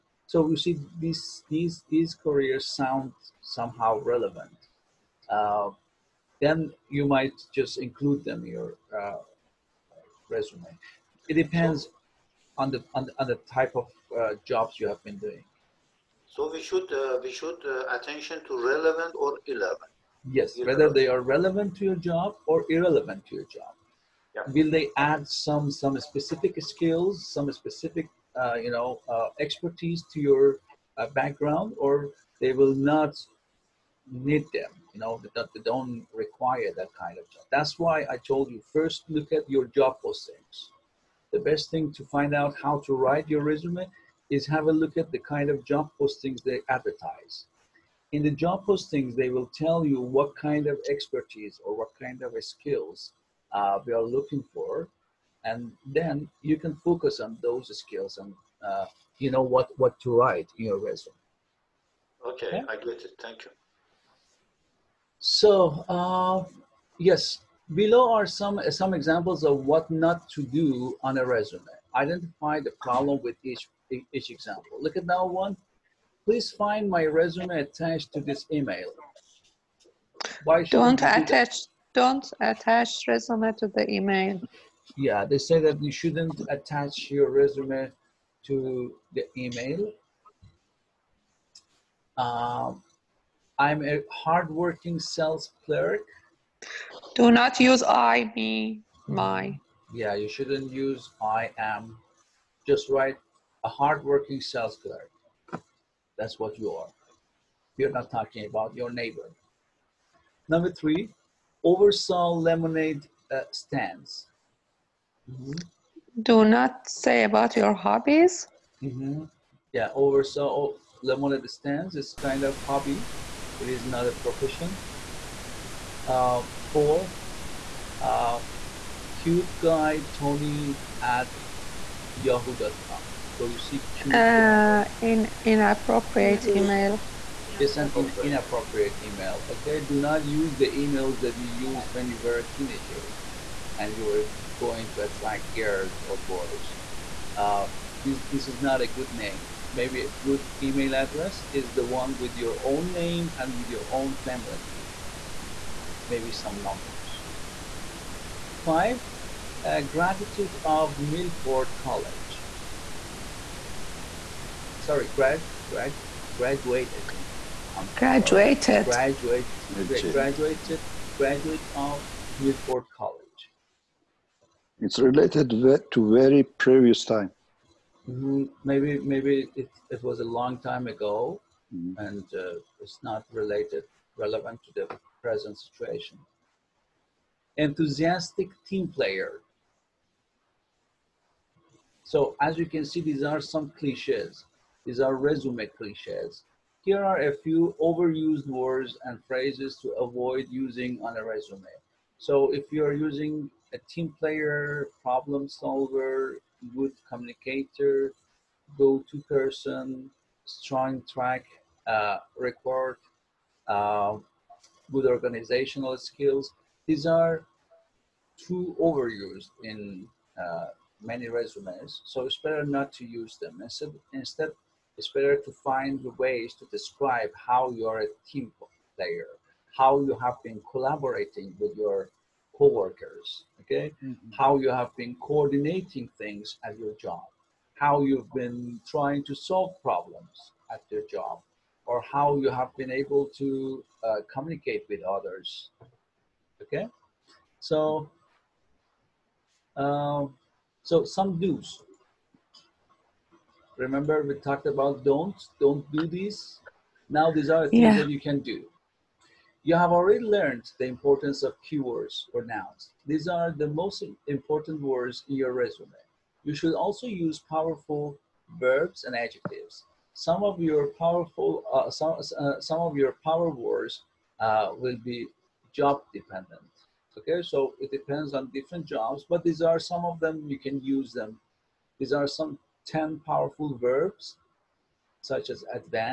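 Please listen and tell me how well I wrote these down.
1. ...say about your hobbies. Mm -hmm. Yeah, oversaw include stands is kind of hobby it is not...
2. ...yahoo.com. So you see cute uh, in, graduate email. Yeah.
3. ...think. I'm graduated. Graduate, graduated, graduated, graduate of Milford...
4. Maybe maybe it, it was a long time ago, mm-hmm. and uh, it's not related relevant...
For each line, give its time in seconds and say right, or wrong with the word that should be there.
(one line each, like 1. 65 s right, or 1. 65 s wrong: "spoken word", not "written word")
1. 117 s wrong: "lemonade", not "include"
2. 132 s wrong: "inappropriate", not "graduate"
3. 167 s right
4. 178 s right.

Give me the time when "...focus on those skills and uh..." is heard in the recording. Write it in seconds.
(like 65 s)
56 s.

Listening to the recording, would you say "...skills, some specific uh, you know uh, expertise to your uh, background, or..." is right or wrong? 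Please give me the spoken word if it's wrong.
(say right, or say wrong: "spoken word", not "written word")
right.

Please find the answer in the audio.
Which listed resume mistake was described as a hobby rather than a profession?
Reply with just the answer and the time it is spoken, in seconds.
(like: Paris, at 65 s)
oversaw lemonade stands, at 111 s.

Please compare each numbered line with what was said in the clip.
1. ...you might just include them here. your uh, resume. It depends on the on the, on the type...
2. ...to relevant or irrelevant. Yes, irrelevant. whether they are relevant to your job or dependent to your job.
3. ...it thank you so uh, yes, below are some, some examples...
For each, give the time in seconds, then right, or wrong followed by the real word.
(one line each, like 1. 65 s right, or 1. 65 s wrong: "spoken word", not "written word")
1. 6 s right
2. 18 s wrong: "irrelevant", not "dependent"
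3. 63 s right.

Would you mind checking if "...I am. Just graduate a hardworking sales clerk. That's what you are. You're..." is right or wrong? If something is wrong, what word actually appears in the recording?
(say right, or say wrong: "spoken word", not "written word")
wrong: "write", not "graduate".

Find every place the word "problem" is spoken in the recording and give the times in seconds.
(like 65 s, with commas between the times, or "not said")
72 s, 205 s, 239 s.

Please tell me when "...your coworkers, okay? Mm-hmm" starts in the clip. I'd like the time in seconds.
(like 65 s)
231 s.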